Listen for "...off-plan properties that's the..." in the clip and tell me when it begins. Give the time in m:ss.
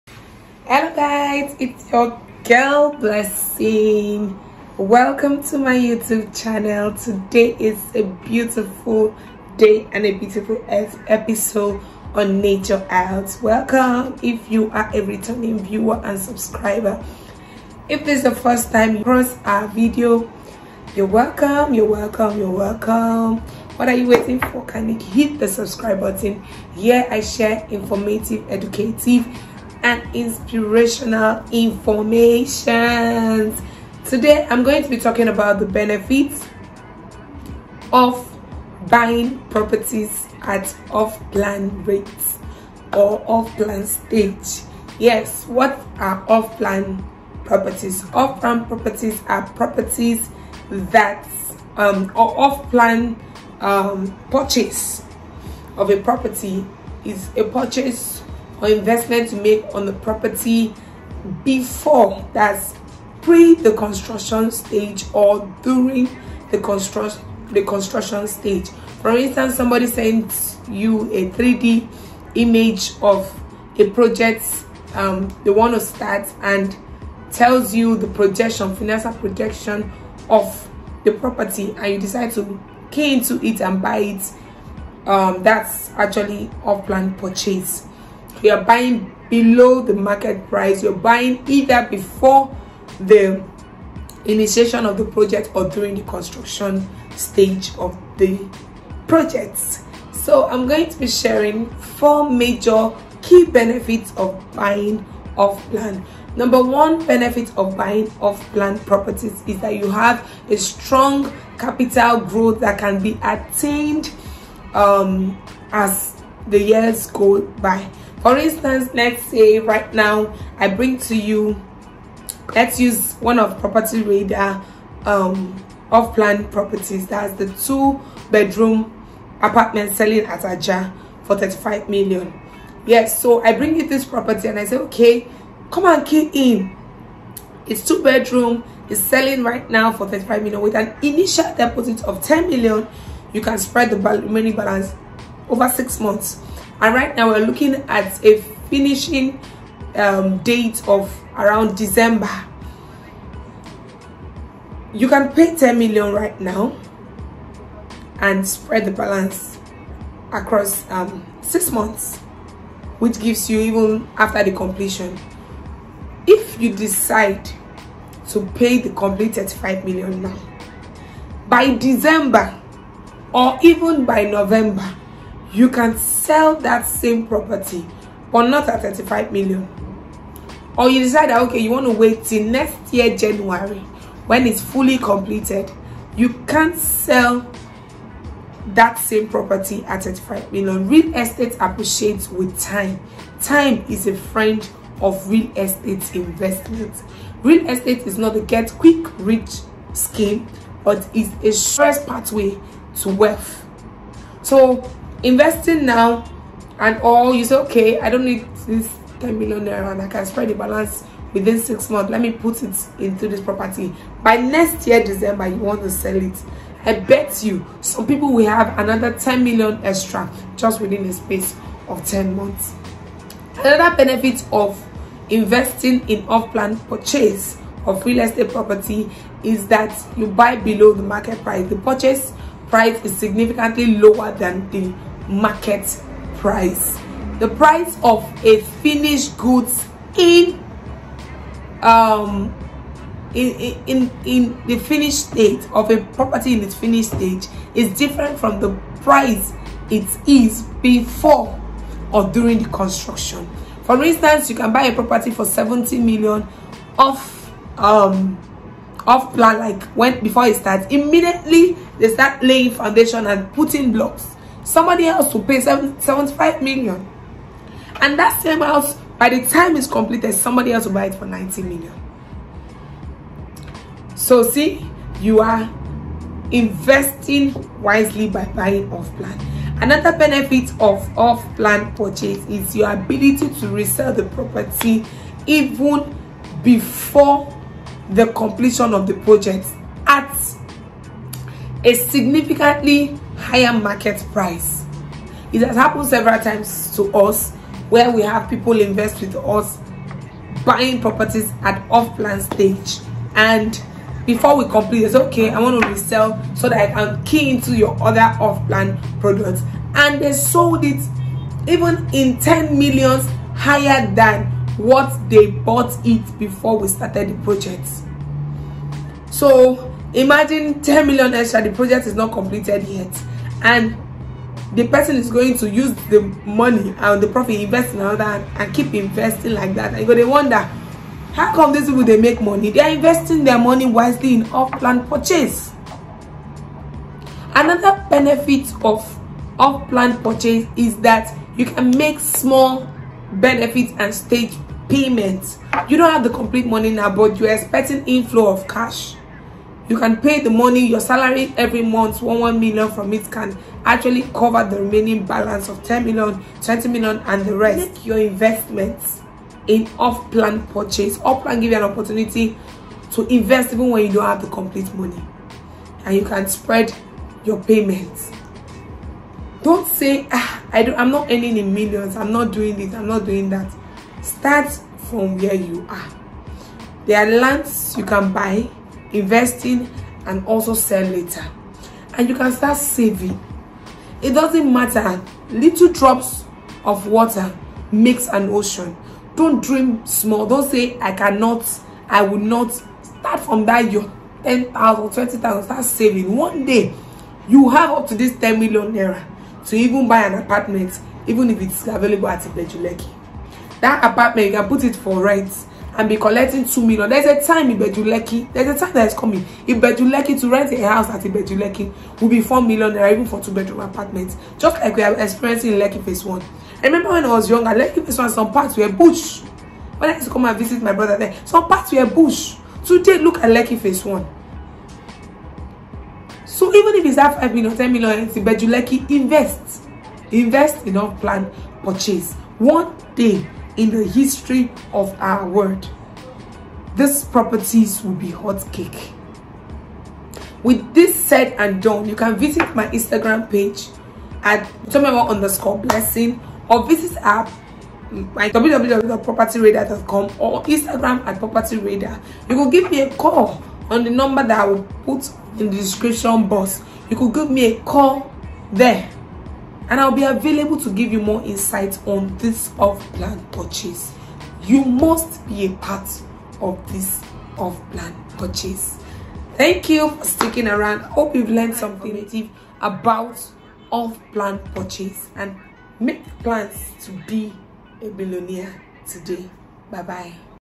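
2:05.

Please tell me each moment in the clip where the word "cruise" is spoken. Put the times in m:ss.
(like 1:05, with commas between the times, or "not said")
not said.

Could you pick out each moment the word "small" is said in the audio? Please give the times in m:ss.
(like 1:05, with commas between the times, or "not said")
5:42, 6:30.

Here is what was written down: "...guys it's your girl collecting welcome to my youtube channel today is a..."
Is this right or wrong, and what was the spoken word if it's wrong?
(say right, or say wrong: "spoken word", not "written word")
wrong: "blessing", not "collecting".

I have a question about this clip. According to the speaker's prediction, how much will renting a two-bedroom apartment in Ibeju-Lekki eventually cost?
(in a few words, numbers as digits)
4 million.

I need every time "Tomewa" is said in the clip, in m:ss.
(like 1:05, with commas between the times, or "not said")
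7:24.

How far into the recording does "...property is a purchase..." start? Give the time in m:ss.
0:56.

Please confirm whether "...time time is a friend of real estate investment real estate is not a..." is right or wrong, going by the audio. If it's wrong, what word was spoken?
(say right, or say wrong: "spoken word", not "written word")
right.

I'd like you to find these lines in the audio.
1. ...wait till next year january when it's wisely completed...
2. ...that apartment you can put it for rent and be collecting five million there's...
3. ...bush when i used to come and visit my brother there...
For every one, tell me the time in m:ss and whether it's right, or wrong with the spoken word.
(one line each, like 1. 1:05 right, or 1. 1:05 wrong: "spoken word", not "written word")
1. 3:01 wrong: "fully", not "wisely"
2. 6:43 wrong: "two", not "five"
3. 6:58 right.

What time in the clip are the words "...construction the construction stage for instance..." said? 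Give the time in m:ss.
1:06.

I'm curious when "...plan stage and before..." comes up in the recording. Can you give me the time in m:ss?
5:02.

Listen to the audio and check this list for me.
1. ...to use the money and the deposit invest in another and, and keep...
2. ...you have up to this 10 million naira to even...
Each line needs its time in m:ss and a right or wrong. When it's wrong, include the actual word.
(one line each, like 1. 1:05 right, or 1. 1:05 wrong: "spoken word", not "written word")
1. 5:25 wrong: "profit", not "deposit"
2. 6:37 right.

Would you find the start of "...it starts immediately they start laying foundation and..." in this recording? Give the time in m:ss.
4:20.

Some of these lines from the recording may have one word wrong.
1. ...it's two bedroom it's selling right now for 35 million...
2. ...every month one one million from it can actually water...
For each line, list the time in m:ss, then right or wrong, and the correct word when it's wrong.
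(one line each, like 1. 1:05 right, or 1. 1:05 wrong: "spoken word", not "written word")
1. 2:17 right
2. 5:51 wrong: "cover", not "water".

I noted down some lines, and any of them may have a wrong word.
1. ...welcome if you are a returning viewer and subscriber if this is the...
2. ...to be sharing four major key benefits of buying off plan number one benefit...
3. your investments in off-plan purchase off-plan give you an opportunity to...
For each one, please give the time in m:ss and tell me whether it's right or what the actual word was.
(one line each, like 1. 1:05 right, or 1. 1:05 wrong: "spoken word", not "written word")
1. 0:13 right
2. 1:40 right
3. 5:58 right.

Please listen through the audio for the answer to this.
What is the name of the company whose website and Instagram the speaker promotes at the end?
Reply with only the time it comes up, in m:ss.
7:31.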